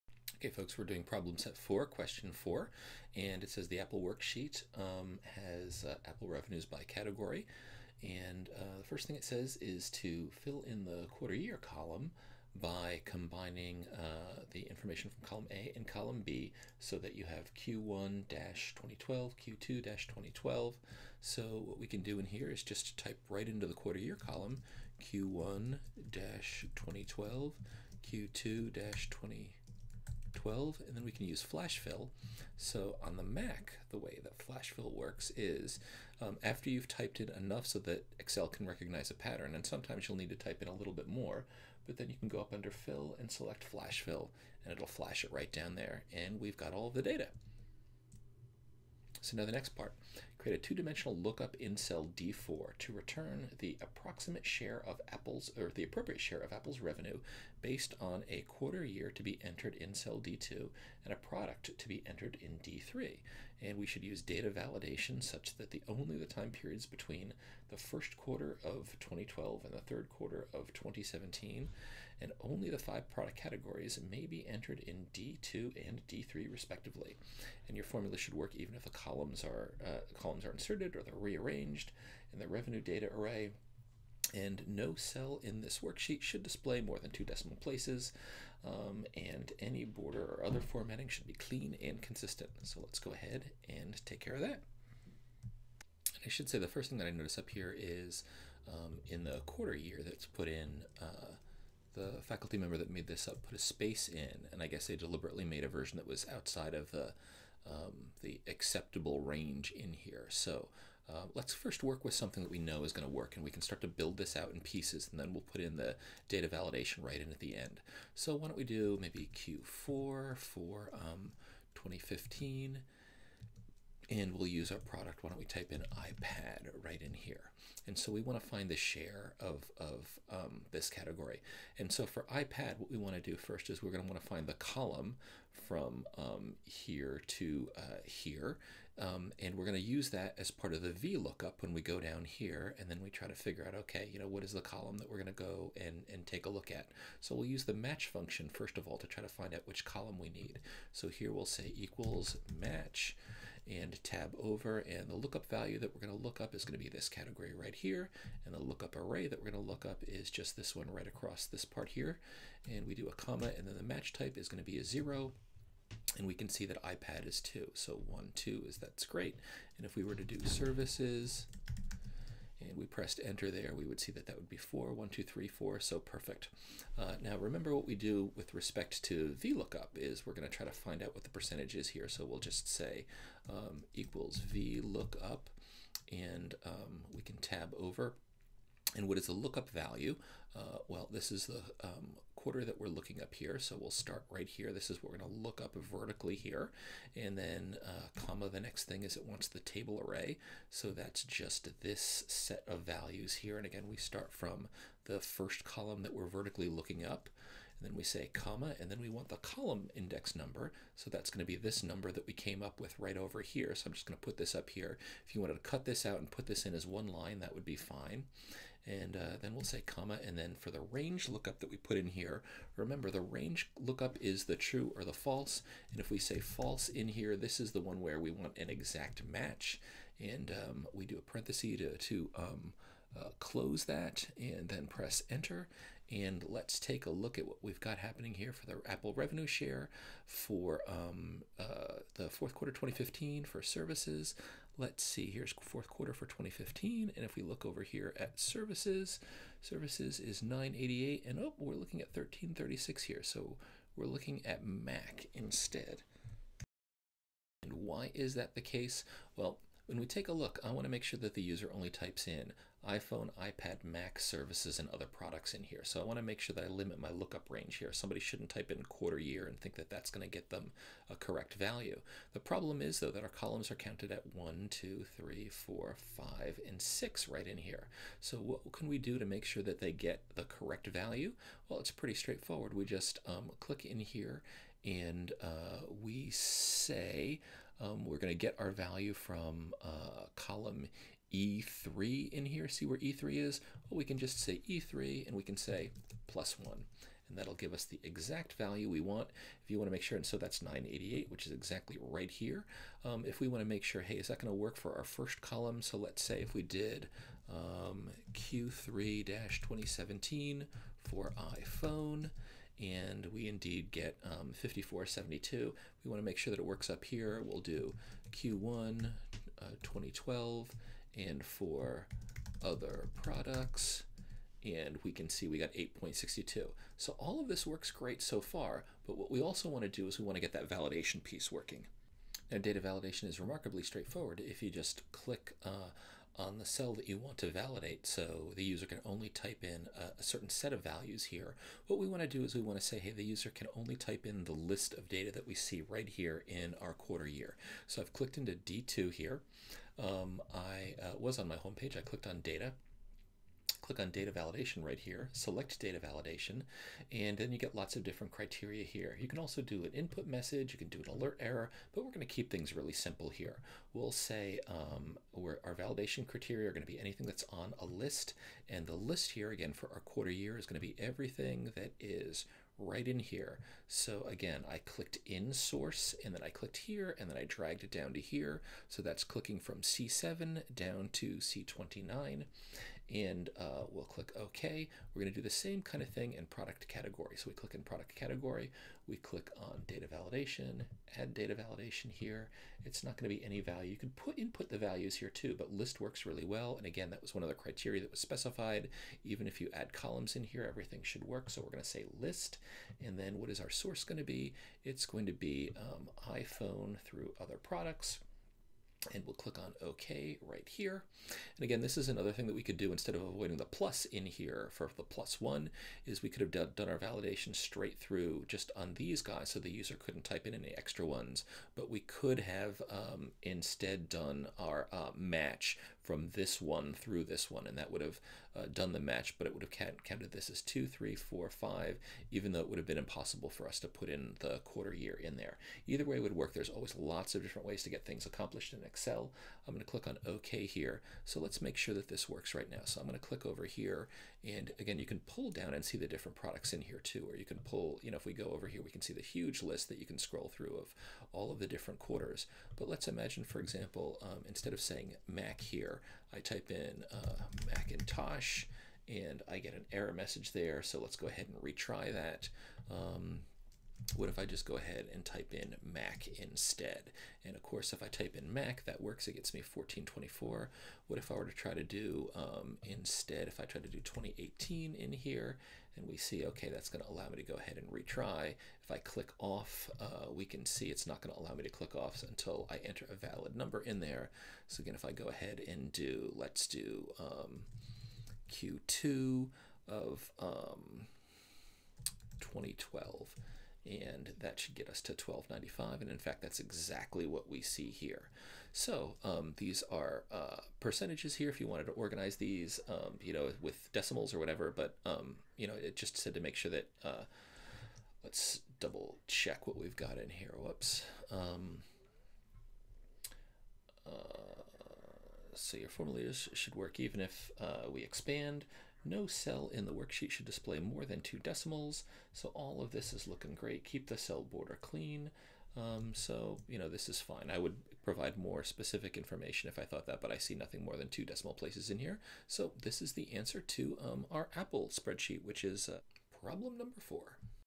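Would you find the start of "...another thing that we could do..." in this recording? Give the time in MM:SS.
06:52.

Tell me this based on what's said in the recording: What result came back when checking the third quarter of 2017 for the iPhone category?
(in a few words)
5472.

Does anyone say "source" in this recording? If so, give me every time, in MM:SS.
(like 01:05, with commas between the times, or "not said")
06:15, 06:43.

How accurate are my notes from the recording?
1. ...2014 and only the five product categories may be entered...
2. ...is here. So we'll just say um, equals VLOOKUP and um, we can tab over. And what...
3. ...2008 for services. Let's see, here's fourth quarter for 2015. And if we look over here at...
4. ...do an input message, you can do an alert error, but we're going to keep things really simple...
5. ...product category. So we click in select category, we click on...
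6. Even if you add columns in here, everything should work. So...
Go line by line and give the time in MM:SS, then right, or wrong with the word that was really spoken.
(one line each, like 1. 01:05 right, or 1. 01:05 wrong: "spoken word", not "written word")
1. 01:10 wrong: "2017", not "2014"
2. 03:01 right
3. 04:02 wrong: "2015", not "2008"
4. 05:59 right
5. 06:26 wrong: "product", not "select"
6. 06:39 right.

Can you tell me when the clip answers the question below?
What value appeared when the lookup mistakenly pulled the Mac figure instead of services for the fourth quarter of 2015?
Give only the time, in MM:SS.
04:12.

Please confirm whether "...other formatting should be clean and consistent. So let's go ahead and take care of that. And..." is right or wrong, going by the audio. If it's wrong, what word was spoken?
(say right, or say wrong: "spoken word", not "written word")
right.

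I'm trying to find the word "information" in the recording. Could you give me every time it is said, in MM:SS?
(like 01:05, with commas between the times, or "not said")
00:14, 08:49.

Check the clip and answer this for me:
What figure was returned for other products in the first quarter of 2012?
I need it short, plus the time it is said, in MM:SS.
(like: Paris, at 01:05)
8.62, at 05:25.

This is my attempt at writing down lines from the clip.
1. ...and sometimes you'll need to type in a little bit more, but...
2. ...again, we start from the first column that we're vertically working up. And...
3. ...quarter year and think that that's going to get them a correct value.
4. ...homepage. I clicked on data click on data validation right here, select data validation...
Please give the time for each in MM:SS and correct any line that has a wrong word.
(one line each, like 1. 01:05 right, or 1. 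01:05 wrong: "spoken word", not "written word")
1. 00:39 right
2. 03:23 wrong: "looking", not "working"
3. 04:28 right
4. 05:51 right.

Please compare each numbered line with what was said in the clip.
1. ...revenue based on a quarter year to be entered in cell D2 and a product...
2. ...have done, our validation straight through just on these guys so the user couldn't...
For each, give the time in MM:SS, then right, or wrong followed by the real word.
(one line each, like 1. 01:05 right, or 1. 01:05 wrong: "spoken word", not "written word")
1. 00:56 right
2. 06:56 right.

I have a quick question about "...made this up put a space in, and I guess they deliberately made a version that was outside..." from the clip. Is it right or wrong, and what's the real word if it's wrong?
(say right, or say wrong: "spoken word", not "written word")
right.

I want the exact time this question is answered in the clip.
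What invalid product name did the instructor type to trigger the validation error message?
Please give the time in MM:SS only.
07:37.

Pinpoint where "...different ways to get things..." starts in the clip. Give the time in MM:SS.
07:17.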